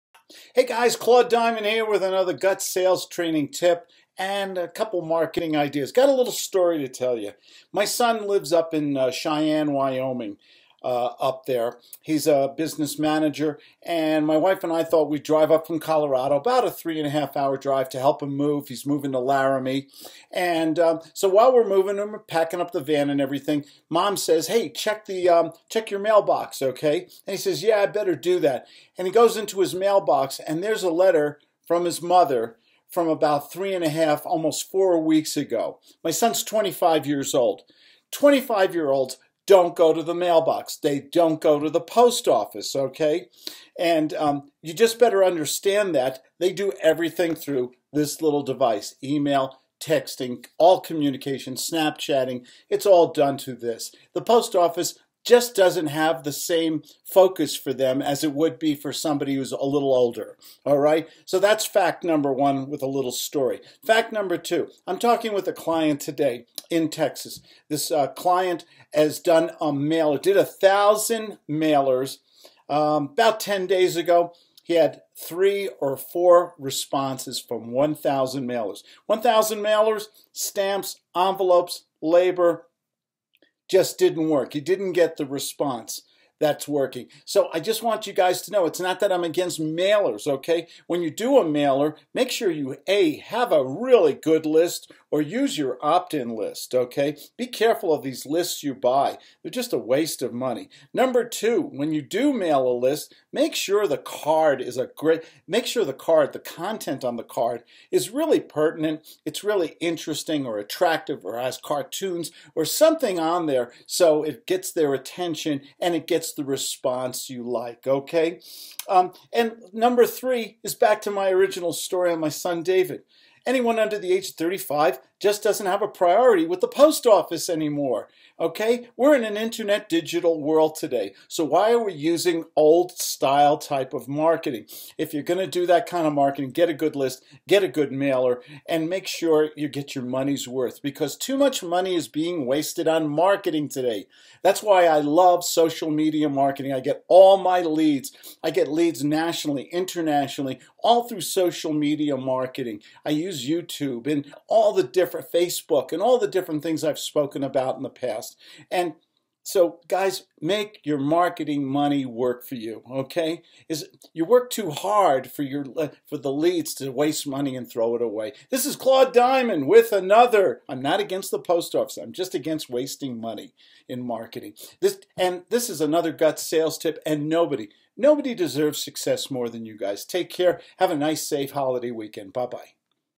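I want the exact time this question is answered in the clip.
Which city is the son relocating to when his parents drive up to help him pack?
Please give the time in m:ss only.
0:19.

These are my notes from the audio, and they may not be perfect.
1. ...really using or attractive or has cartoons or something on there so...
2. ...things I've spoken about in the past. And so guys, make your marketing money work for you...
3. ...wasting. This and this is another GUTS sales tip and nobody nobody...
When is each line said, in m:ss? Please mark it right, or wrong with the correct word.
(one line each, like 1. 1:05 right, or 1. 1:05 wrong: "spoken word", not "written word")
1. 1:49 wrong: "interesting", not "using"
2. 2:36 right
3. 2:54 wrong: "marketing", not "wasting".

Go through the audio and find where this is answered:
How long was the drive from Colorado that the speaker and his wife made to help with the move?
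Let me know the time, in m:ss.
0:16.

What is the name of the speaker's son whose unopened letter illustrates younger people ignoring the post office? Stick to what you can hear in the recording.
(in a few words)
David.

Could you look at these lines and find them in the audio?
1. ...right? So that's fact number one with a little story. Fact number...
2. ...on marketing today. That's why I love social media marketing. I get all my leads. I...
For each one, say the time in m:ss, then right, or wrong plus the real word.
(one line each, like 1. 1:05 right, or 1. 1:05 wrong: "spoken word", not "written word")
1. 1:00 right
2. 2:22 right.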